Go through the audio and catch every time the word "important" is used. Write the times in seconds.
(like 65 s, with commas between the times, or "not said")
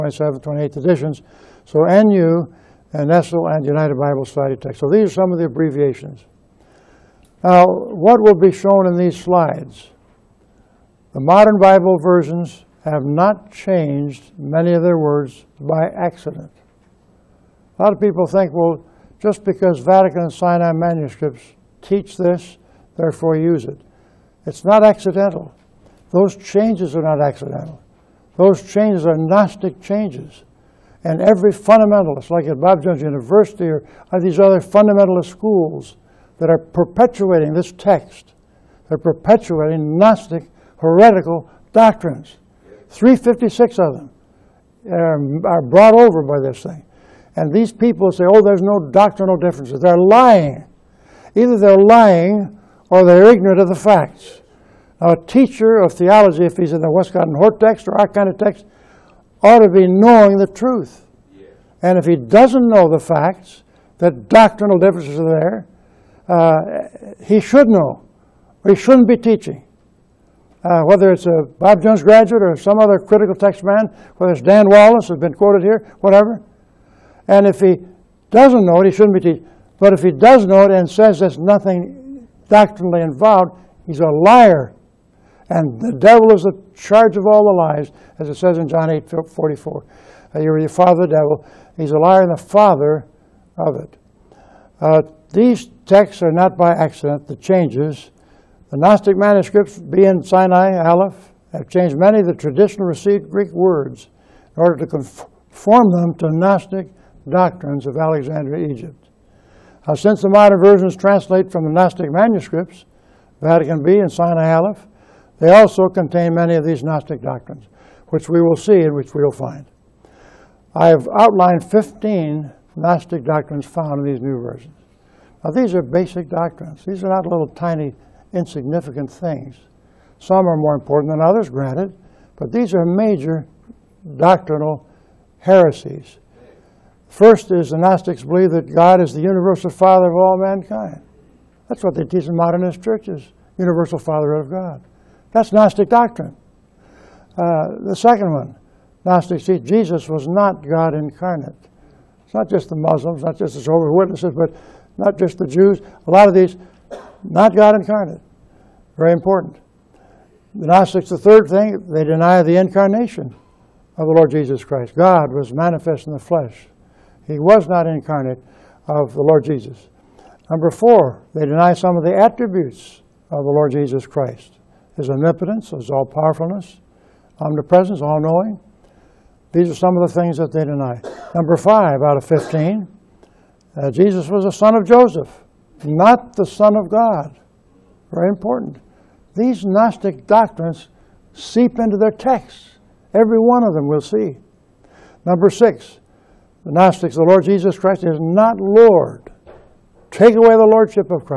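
130 s, 159 s, 188 s.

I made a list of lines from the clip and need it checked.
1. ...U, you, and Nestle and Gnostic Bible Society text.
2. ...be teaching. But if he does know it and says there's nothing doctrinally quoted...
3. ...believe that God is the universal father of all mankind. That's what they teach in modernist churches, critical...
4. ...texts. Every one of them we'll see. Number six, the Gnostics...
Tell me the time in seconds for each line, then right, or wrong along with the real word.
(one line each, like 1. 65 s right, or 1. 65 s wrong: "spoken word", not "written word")
1. 2 s wrong: "United", not "Gnostic"
2. 79 s wrong: "involved", not "quoted"
3. 138 s wrong: "universal", not "critical"
4. 192 s right.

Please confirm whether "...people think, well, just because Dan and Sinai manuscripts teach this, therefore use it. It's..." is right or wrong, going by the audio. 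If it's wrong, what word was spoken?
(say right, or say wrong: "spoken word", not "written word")
wrong: "Vatican", not "Dan".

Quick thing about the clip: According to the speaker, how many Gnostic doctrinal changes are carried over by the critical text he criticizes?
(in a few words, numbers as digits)
356.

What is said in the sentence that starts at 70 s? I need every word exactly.
Uh, whether it's a Bob Jones graduate or some other critical text man, whether it's Dan Wallace, has been quoted here, whatever.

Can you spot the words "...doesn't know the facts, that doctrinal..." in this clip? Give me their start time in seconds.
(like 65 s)
62 s.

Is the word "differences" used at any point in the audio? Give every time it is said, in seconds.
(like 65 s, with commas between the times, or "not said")
49 s, 64 s.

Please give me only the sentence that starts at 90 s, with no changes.
Uh, you're the father of the devil.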